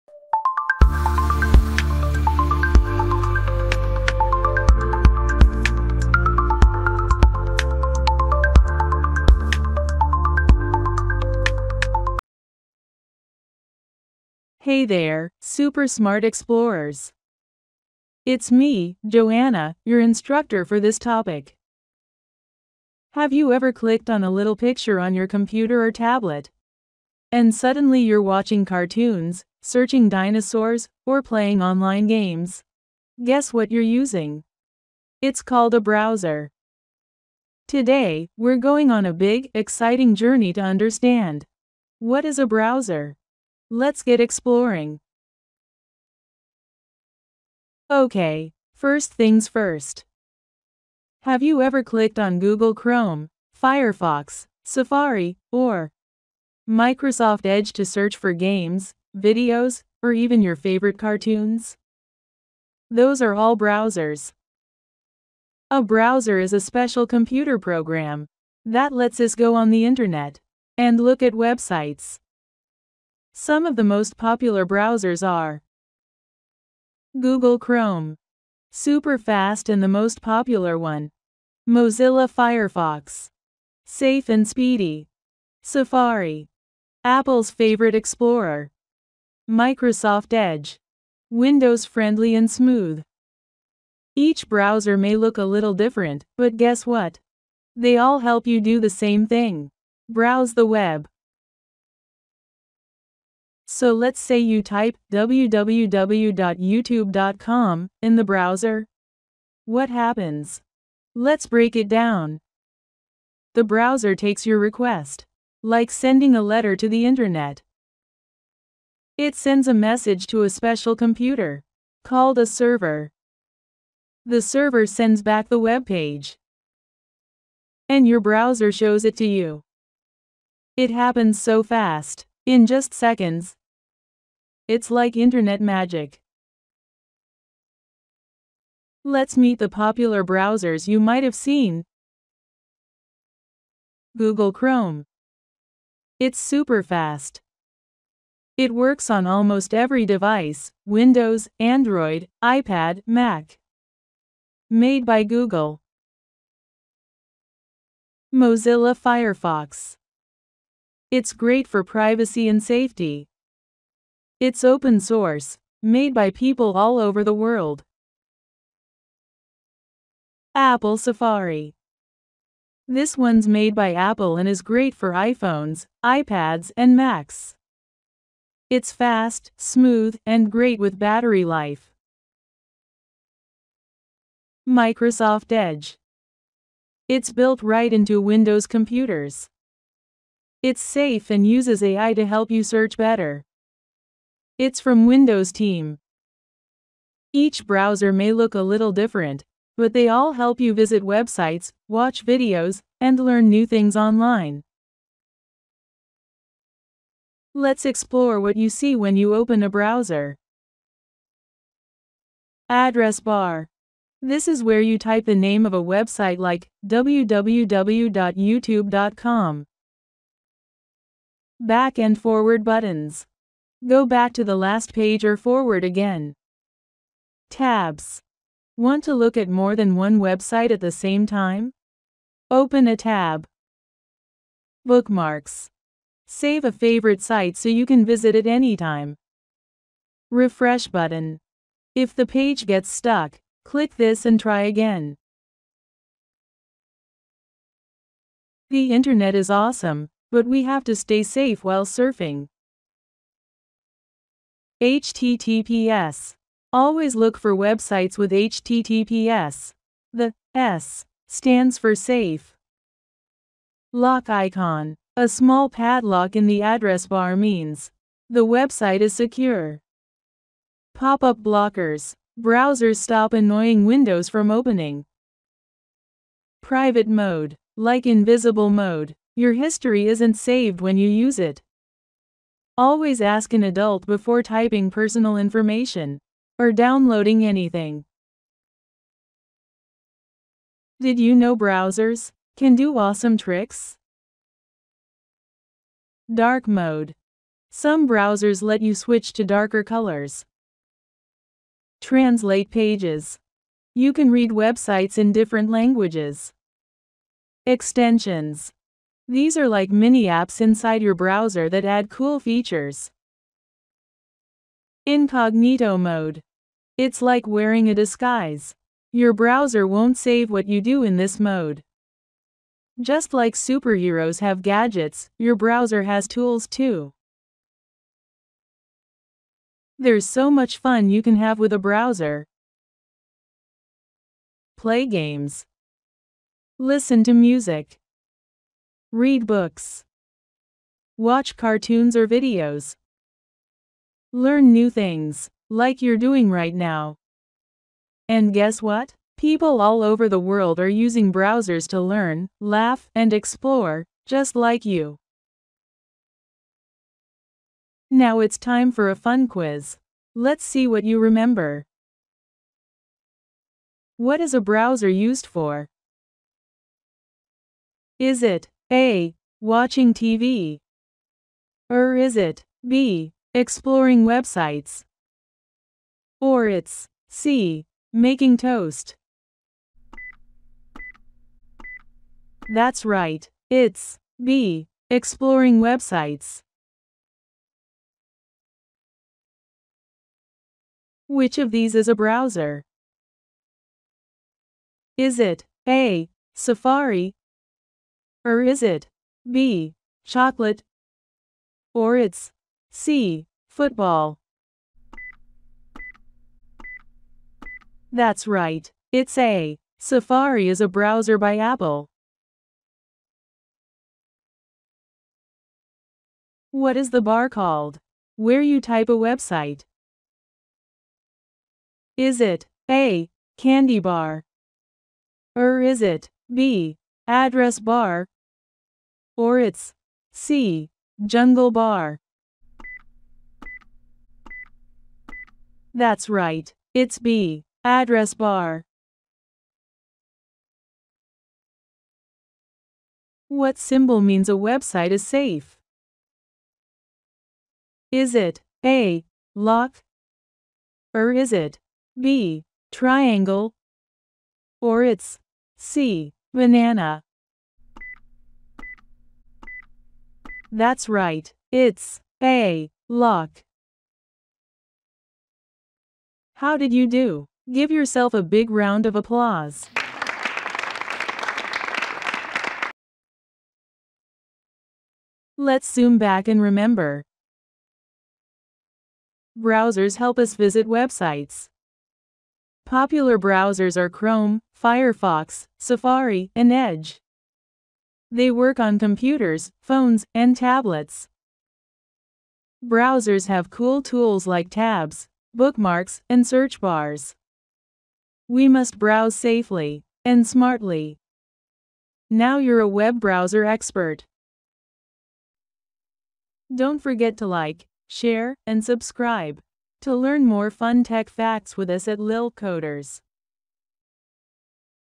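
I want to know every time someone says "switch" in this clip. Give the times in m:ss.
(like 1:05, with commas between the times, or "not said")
4:58.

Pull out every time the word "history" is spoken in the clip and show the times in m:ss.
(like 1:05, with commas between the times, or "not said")
4:39.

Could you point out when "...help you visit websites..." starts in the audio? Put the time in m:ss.
3:20.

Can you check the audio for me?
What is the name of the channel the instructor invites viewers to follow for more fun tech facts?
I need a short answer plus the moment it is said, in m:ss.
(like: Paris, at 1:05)
Lil Coders, at 8:32.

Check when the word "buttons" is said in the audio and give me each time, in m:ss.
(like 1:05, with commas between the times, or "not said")
3:42, 4:00.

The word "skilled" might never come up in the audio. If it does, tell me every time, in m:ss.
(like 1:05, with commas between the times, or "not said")
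not said.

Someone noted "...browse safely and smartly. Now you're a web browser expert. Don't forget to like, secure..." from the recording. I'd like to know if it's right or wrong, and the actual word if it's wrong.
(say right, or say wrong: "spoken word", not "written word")
wrong: "share", not "secure".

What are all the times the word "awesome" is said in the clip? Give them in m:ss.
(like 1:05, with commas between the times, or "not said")
4:09, 4:52.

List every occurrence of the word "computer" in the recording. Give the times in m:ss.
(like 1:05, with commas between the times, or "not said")
0:25, 1:07, 2:00, 3:08, 8:08.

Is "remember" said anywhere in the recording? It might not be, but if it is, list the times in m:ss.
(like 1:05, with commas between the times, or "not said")
6:01, 7:56.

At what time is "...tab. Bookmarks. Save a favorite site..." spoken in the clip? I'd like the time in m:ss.
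3:52.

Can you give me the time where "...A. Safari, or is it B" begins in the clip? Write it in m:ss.
6:35.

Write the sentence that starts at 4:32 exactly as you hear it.
Browsers stop annoying windows from opening.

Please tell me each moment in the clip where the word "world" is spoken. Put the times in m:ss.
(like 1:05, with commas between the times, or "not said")
2:47, 5:50.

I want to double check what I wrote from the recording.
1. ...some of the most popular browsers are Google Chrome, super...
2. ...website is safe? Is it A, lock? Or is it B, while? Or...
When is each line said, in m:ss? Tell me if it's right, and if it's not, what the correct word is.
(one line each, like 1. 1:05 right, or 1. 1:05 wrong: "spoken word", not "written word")
1. 1:13 right
2. 7:24 wrong: "triangle", not "while".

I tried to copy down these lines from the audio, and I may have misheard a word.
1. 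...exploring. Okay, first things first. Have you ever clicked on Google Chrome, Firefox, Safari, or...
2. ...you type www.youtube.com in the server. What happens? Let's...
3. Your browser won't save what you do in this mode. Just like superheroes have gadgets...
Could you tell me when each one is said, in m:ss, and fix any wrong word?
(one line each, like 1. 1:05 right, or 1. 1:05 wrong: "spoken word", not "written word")
1. 0:44 right
2. 1:44 wrong: "browser", not "server"
3. 5:19 right.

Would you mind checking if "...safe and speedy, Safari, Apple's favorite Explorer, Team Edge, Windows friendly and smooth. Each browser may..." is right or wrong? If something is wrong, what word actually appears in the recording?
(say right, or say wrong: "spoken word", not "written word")
wrong: "Microsoft", not "Team".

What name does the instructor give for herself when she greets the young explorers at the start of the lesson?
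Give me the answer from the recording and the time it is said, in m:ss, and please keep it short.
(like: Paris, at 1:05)
Joanna, at 0:19.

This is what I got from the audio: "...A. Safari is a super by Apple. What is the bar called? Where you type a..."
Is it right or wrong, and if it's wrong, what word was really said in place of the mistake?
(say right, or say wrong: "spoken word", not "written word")
wrong: "browser", not "super".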